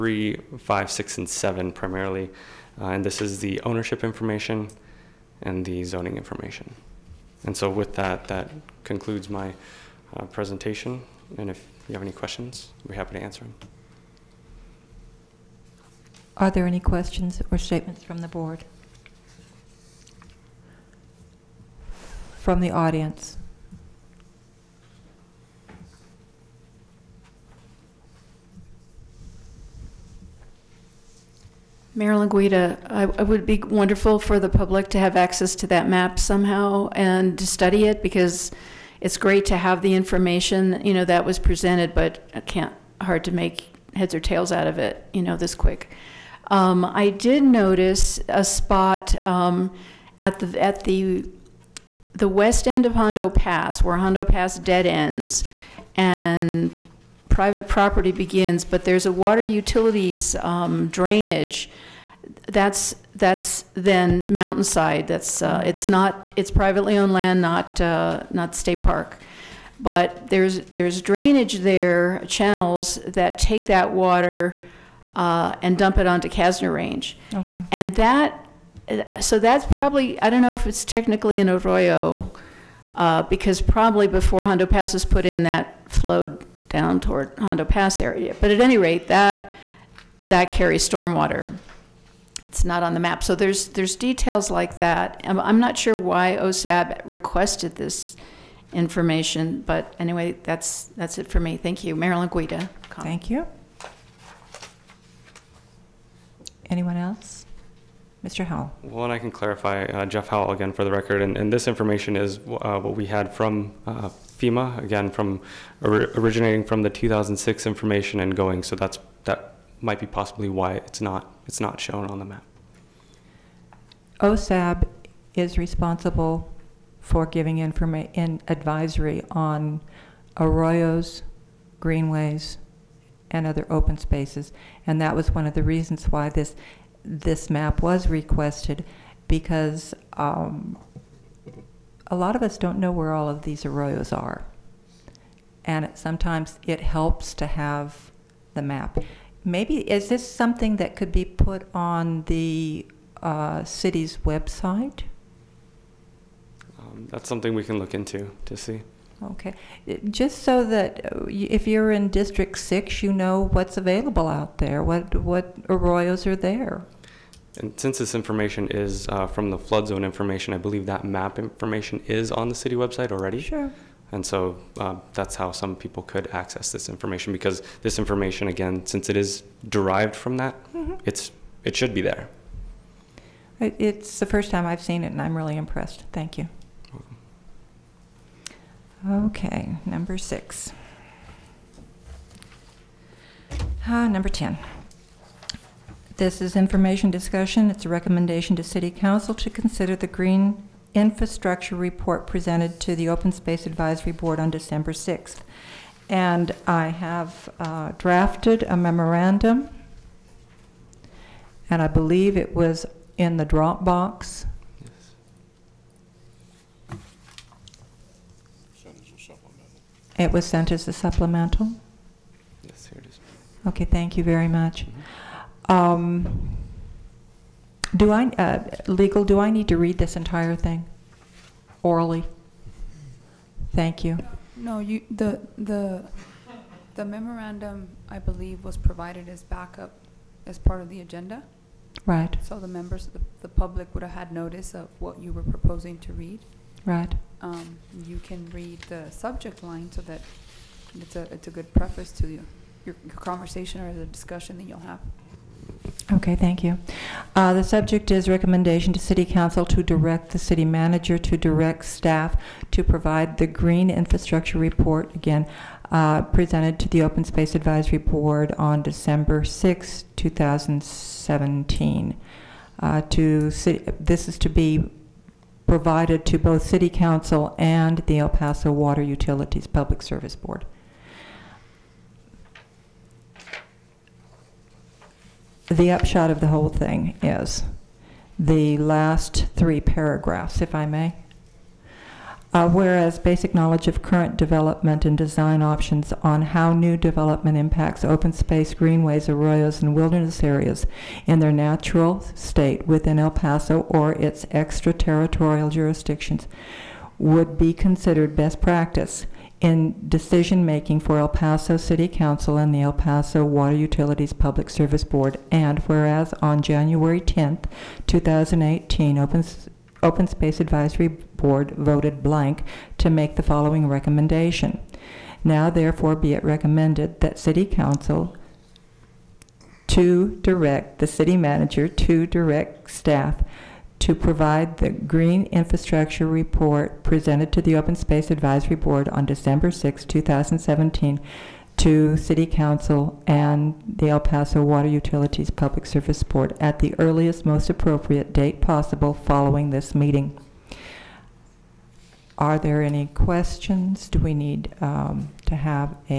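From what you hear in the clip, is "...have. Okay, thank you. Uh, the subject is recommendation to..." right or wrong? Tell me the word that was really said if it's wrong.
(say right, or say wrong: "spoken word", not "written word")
right.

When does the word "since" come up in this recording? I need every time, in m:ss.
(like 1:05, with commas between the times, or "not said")
2:47, 2:58.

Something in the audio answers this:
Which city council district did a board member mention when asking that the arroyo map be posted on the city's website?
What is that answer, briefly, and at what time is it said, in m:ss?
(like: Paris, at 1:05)
District Six, at 2:42.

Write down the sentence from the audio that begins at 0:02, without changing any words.
Uh, and this is the ownership information and the zoning information.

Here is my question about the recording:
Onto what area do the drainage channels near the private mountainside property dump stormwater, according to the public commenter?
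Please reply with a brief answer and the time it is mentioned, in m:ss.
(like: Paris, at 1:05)
Castner Range, at 1:16.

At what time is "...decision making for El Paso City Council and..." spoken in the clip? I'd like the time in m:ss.
5:10.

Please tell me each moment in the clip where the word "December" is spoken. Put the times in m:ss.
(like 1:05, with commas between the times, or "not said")
3:24, 4:28, 5:39.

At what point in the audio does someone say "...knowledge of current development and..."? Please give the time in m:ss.
4:53.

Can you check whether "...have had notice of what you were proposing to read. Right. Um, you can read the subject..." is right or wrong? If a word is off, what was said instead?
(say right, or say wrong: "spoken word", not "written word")
right.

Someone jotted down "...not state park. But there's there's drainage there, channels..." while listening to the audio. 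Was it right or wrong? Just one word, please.
right.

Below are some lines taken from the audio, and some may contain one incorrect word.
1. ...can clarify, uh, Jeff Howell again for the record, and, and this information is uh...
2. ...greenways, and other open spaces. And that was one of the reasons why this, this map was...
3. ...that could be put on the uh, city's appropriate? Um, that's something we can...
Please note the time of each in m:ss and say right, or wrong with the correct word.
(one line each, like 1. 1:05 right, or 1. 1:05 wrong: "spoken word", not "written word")
1. 1:49 right
2. 2:11 right
3. 2:30 wrong: "website", not "appropriate".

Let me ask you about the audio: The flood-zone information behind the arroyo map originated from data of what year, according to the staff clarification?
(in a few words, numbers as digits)
2006.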